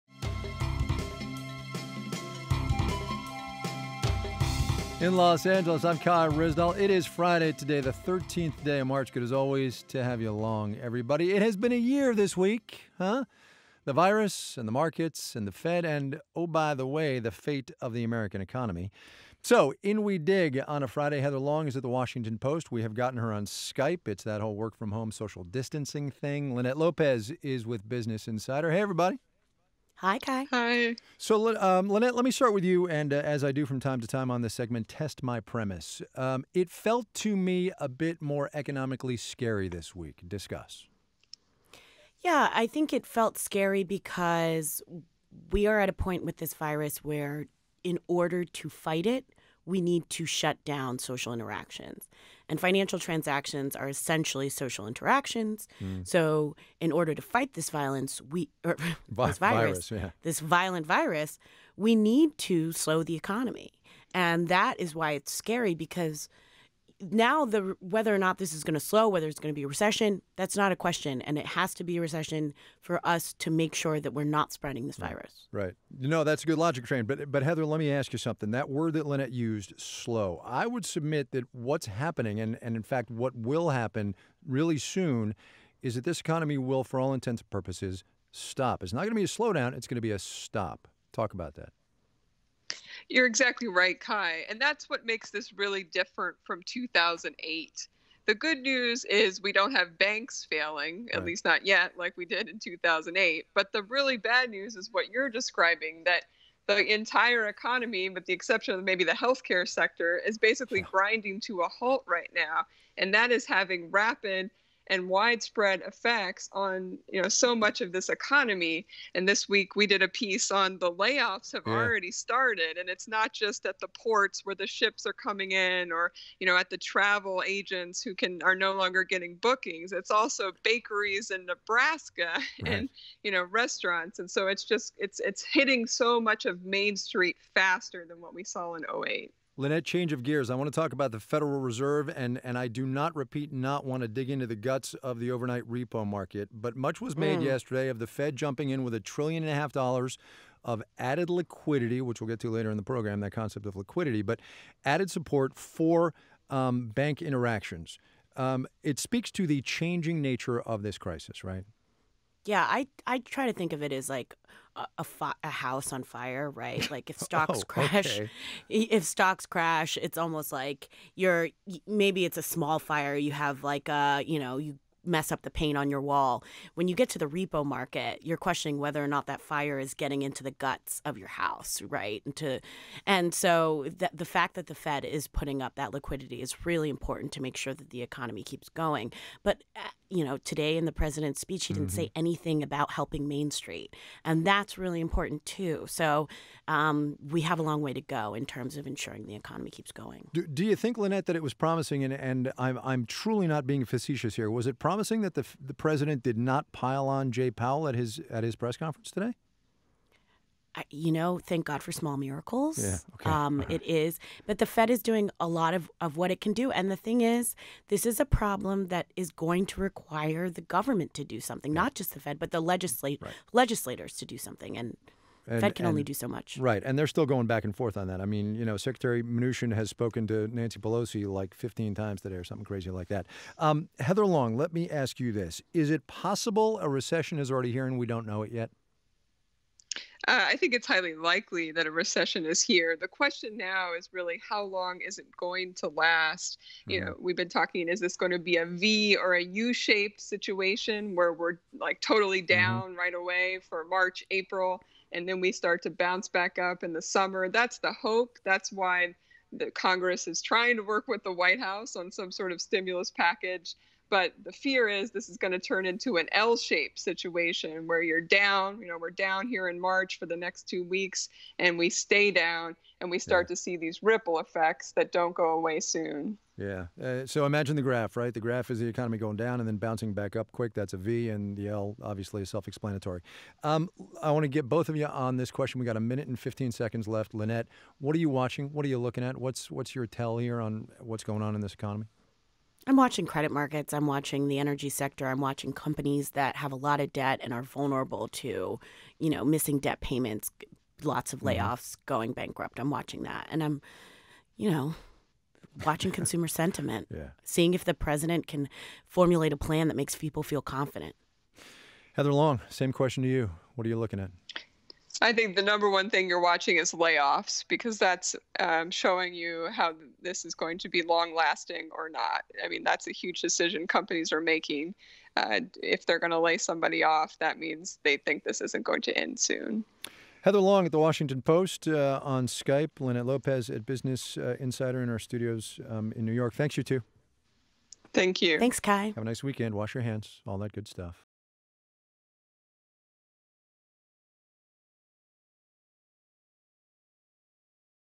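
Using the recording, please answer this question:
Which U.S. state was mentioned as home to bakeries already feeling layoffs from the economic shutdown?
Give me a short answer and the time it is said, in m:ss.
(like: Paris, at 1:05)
Nebraska, at 2:11.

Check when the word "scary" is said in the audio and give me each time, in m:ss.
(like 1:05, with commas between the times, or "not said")
0:39, 0:43, 1:05.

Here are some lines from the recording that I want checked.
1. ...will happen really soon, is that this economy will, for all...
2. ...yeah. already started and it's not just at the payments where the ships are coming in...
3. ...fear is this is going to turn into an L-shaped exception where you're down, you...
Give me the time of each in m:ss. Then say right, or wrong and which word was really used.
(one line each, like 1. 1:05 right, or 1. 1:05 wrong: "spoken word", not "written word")
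1. 1:23 right
2. 2:01 wrong: "ports", not "payments"
3. 4:24 wrong: "situation", not "exception".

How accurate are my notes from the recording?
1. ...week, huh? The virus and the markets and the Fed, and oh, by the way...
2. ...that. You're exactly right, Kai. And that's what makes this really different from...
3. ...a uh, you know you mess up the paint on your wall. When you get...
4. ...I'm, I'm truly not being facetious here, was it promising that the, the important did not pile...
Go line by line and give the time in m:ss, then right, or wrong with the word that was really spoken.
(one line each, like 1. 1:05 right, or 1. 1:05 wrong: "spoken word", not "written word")
1. 0:12 right
2. 1:31 right
3. 2:53 right
4. 3:22 wrong: "president", not "important".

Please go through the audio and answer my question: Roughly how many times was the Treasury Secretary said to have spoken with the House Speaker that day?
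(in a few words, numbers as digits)
15.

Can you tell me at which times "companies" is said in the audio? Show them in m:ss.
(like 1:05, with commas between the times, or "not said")
4:55, 5:23.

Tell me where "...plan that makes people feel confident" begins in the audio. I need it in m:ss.
5:09.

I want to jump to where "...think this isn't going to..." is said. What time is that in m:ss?
5:28.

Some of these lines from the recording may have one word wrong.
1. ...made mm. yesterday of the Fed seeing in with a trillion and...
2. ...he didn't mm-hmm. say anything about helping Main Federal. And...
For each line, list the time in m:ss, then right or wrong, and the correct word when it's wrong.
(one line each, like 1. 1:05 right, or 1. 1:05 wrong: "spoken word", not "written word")
1. 2:27 wrong: "jumping", not "seeing"
2. 3:11 wrong: "Street", not "Federal".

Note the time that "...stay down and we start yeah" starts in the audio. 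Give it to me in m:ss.
4:31.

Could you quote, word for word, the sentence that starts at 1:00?
this violent virus, we need to slow the economy.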